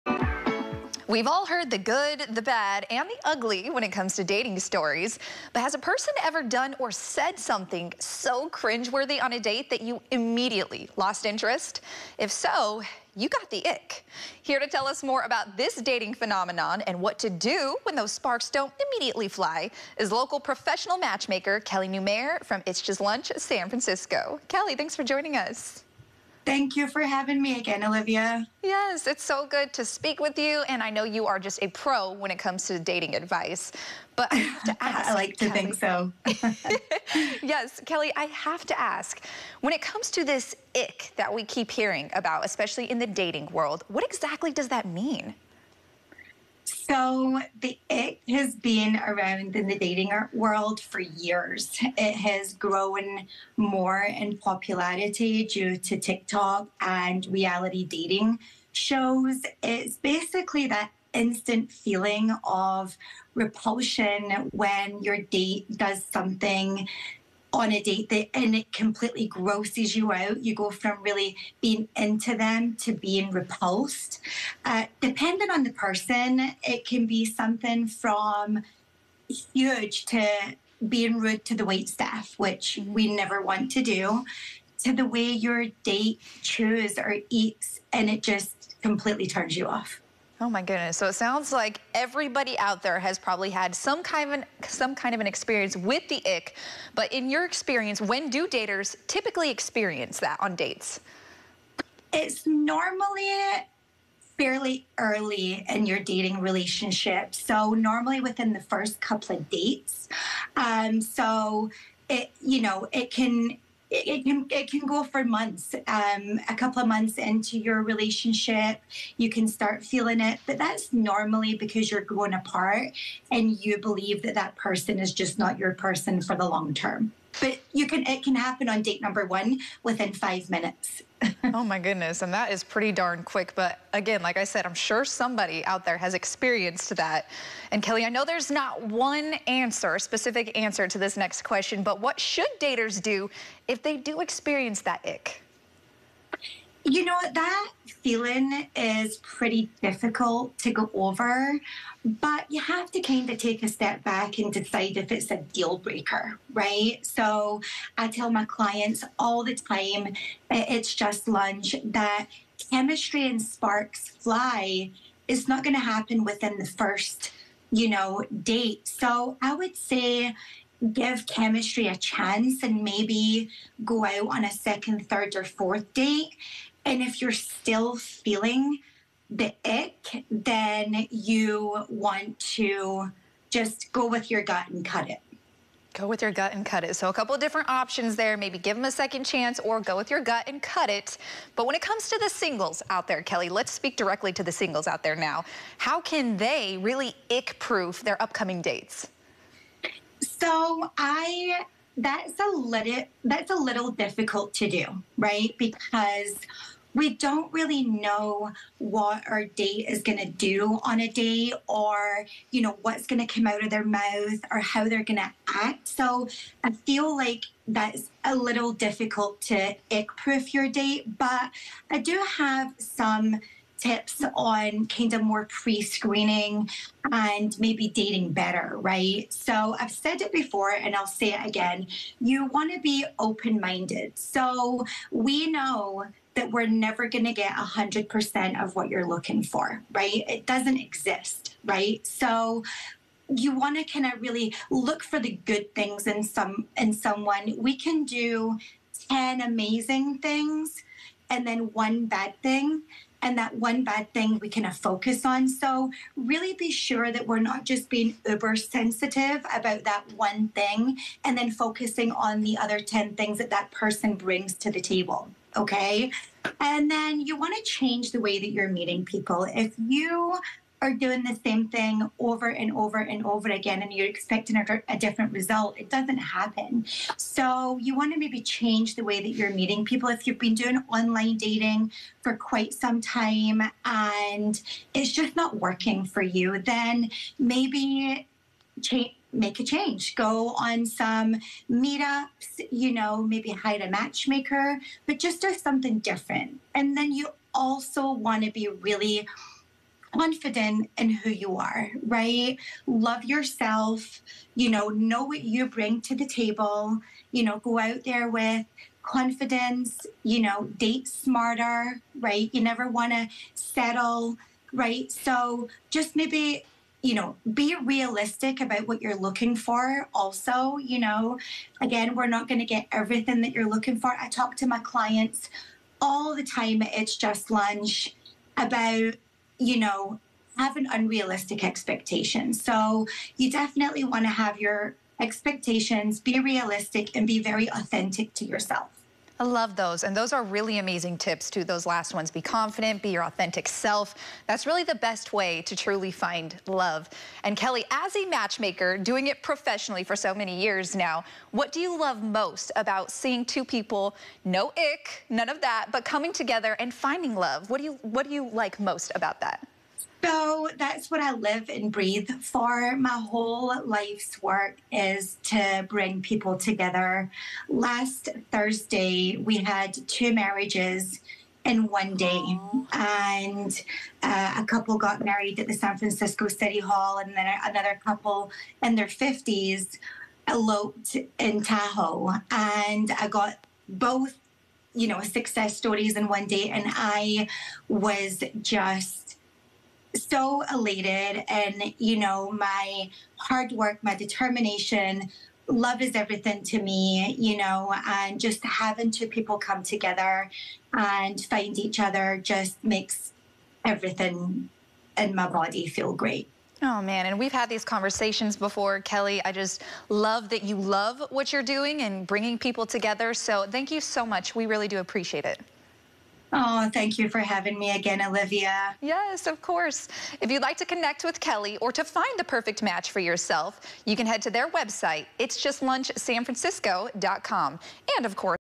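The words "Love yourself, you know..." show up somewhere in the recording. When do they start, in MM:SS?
05:02.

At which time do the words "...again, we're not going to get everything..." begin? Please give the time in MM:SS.
05:21.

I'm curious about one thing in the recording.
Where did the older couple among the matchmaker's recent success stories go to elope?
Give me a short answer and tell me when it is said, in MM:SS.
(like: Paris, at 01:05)
Tahoe, at 06:21.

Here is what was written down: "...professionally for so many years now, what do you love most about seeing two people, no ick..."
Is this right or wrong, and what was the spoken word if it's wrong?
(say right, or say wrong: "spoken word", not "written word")
right.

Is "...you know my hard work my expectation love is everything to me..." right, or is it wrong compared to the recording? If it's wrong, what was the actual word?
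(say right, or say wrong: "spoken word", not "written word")
wrong: "determination", not "expectation".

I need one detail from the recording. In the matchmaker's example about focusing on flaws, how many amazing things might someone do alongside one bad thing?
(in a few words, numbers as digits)
10.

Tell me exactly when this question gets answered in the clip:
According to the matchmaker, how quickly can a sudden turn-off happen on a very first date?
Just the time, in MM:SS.
02:09.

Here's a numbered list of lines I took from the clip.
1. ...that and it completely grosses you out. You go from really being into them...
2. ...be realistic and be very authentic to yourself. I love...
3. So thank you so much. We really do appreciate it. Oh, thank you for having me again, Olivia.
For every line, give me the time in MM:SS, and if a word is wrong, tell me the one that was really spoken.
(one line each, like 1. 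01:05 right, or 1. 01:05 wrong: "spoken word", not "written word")
1. 01:08 right
2. 05:36 right
3. 06:53 right.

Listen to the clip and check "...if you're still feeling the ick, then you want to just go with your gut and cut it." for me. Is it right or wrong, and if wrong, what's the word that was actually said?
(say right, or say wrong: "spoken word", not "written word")
right.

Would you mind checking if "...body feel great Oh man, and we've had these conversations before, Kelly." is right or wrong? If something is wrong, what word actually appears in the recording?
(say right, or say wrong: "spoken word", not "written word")
right.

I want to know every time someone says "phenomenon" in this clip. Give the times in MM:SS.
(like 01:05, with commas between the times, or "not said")
00:16.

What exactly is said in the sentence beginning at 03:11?
But when it comes to the singles out there, Kelly, let's speak directly to the singles out there now.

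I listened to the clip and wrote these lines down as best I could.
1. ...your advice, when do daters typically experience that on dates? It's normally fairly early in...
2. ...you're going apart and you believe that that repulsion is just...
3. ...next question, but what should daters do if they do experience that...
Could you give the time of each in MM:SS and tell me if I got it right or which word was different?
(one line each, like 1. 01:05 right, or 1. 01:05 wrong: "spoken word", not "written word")
1. 01:37 wrong: "experience", not "advice"
2. 02:01 wrong: "person", not "repulsion"
3. 02:21 right.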